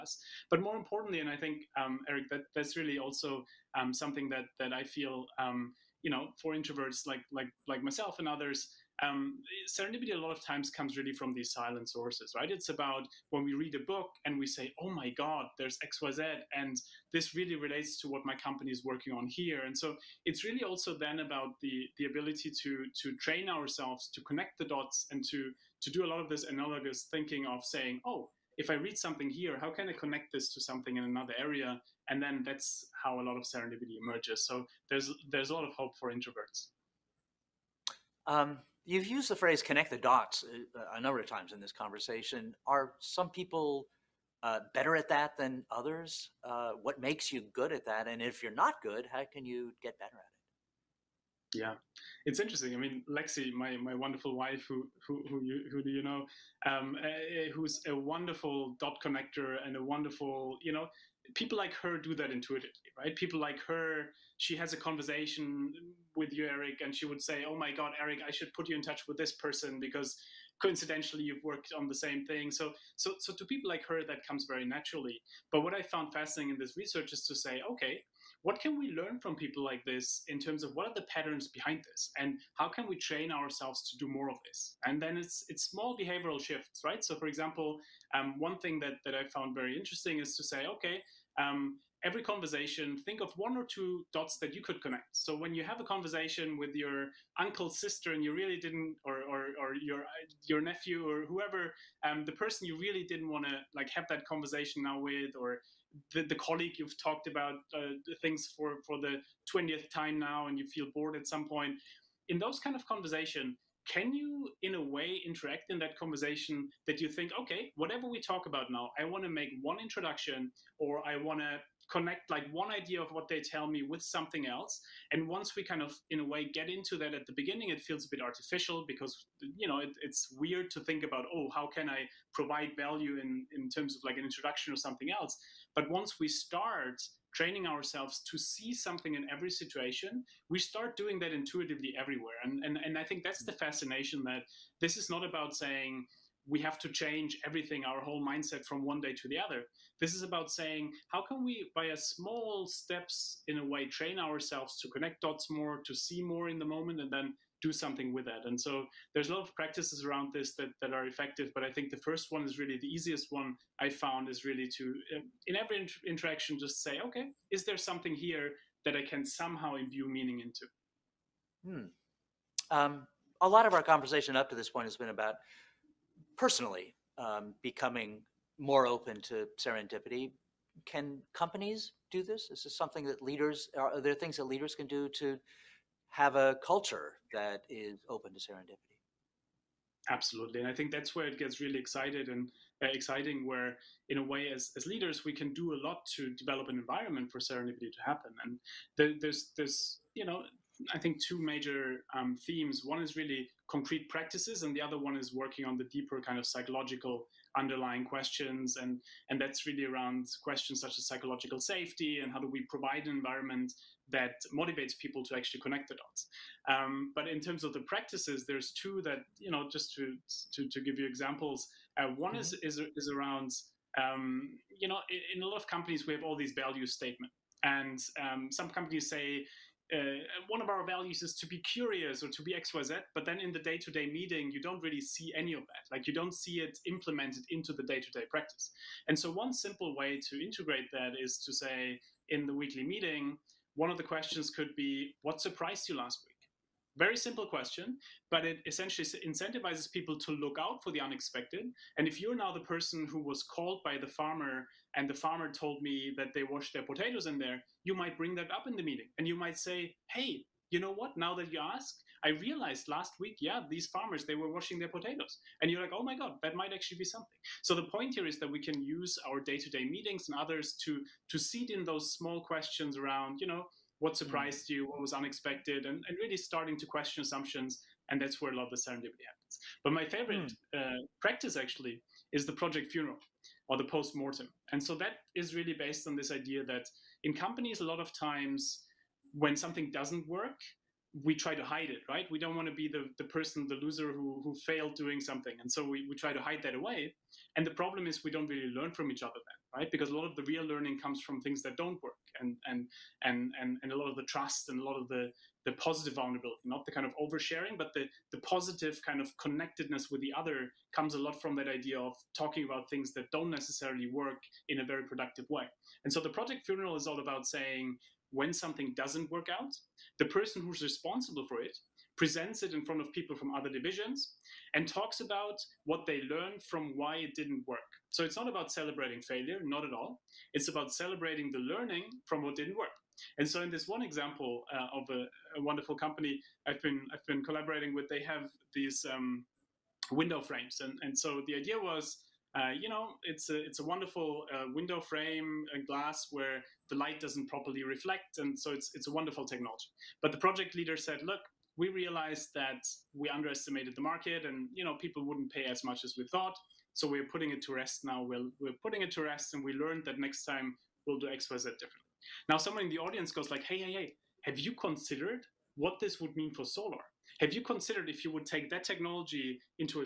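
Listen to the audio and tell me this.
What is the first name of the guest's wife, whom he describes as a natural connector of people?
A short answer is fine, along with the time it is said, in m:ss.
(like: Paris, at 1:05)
Lexi, at 0:53.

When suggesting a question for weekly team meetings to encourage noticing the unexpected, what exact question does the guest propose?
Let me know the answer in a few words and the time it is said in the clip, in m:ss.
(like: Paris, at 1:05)
What surprised you last week?, at 4:05.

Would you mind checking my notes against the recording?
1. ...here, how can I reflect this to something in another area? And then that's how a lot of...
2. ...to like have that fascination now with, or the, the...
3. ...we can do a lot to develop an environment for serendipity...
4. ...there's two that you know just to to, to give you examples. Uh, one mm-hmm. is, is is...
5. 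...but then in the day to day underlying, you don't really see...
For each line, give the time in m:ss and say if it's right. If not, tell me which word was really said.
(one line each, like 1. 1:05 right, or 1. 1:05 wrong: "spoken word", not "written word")
1. 0:29 wrong: "connect", not "reflect"
2. 1:43 wrong: "conversation", not "fascination"
3. 3:15 right
4. 3:38 right
5. 3:53 wrong: "meeting", not "underlying".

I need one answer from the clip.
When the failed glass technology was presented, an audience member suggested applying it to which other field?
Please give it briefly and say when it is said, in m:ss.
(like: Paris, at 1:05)
Solar, at 6:06.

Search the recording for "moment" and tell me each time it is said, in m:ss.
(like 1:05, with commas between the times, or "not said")
2:36.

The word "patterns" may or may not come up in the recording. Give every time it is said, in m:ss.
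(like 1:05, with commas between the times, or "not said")
1:21.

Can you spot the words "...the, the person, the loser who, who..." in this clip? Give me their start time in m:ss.
4:52.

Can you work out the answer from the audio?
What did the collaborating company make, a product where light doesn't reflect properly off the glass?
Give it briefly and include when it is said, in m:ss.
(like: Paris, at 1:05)
Window frames, at 5:40.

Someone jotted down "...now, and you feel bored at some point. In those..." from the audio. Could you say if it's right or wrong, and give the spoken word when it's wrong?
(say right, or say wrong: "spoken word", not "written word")
right.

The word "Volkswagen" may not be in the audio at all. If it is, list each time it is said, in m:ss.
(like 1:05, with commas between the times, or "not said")
not said.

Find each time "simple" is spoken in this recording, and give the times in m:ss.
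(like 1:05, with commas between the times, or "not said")
3:59, 4:07.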